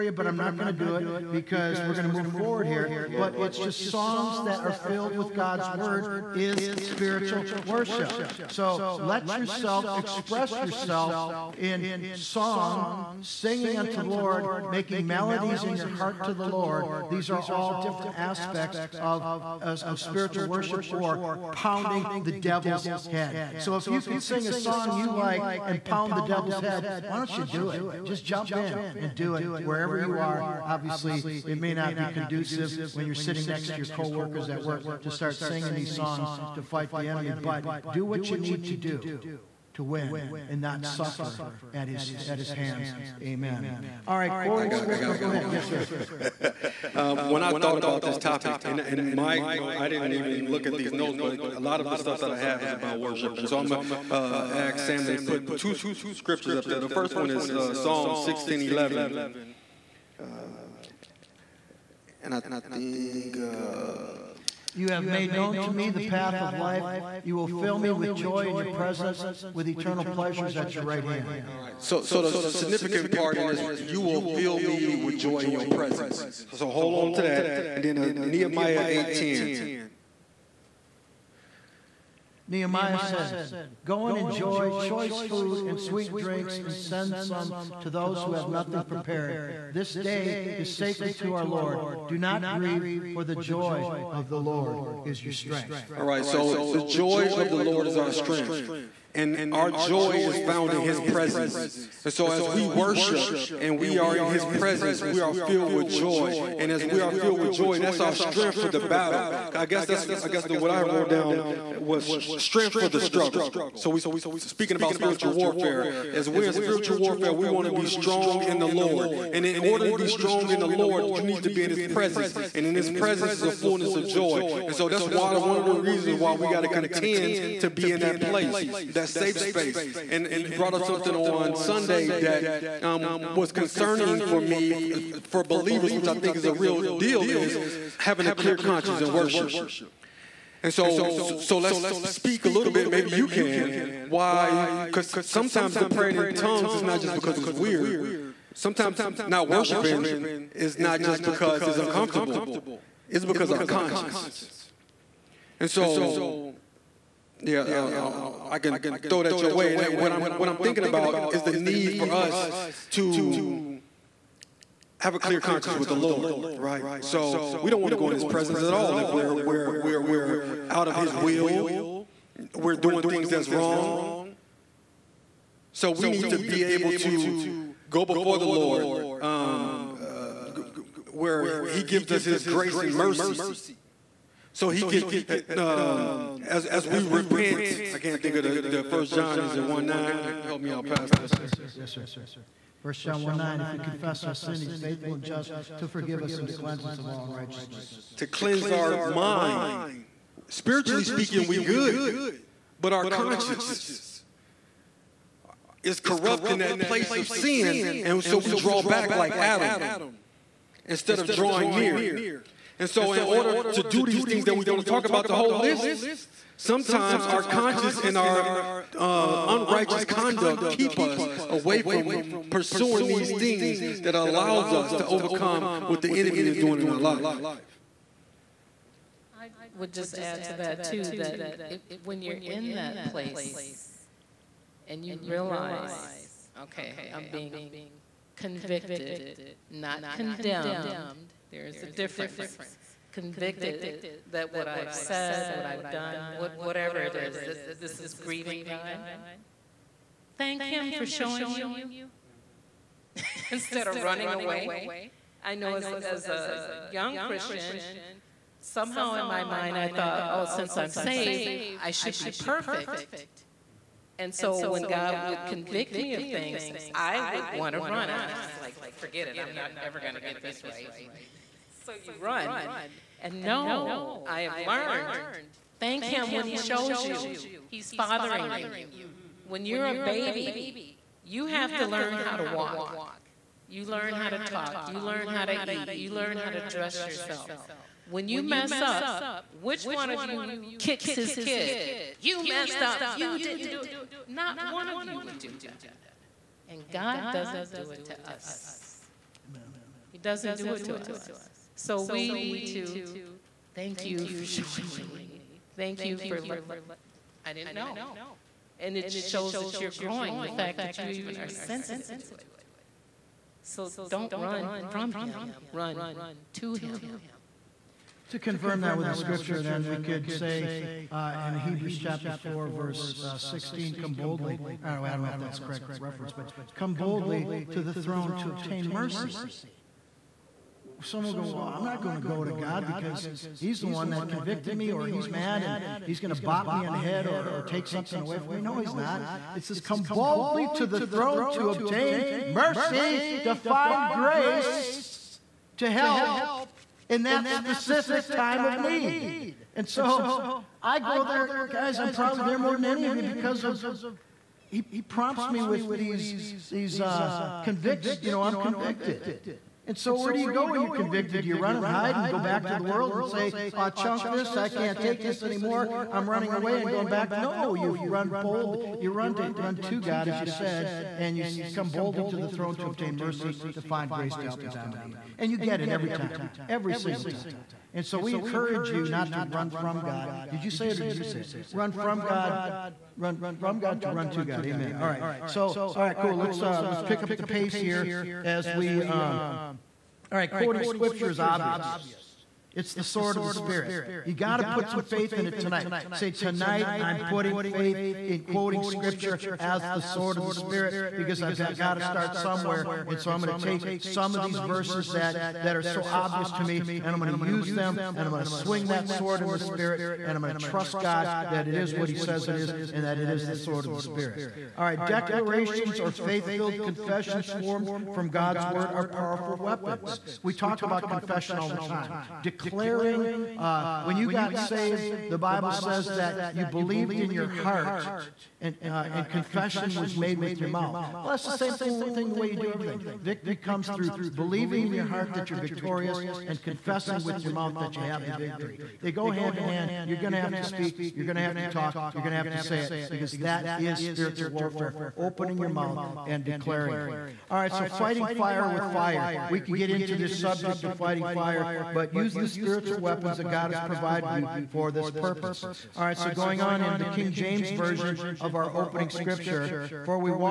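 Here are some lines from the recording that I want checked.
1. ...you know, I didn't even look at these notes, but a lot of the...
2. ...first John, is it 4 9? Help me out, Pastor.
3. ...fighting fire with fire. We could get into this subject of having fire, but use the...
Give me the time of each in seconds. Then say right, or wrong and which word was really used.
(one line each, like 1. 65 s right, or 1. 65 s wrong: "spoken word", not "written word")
1. 49 s right
2. 188 s wrong: "1", not "4"
3. 447 s wrong: "fighting", not "having".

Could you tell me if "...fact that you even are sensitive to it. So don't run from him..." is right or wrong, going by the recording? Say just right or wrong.
right.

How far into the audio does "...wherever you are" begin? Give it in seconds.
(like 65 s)
29 s.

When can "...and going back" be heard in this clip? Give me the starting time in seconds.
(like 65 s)
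366 s.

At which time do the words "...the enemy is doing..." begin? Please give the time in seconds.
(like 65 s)
226 s.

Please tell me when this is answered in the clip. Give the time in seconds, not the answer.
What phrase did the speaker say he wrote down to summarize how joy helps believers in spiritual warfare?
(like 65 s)
112 s.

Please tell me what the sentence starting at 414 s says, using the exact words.
All right, declarations or faith filled confessions formed from God's word are powerful weapons.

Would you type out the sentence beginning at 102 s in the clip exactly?
And so, as we worship and we are in his presence, we are filled with joy.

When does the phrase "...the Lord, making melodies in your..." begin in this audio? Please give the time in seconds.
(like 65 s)
14 s.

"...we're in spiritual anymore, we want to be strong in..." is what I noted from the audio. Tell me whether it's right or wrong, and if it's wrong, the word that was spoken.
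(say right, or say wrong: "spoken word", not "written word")
wrong: "warfare", not "anymore".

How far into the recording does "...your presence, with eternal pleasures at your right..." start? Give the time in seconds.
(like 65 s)
68 s.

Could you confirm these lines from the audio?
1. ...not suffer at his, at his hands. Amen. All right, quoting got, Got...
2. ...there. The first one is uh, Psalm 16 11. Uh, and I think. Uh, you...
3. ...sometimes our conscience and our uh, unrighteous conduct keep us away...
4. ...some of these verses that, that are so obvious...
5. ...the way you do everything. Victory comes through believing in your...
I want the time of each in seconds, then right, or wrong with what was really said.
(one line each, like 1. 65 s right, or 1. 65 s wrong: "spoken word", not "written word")
1. 40 s right
2. 56 s right
3. 216 s right
4. 404 s right
5. 432 s right.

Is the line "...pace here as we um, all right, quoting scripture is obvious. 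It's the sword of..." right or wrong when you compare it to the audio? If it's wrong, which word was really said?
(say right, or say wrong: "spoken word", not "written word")
right.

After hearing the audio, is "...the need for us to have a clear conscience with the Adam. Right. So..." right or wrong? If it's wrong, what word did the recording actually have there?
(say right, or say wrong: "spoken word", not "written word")
wrong: "Lord", not "Adam".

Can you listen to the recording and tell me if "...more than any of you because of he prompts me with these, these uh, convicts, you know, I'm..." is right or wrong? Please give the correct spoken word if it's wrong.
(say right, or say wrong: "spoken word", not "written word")
right.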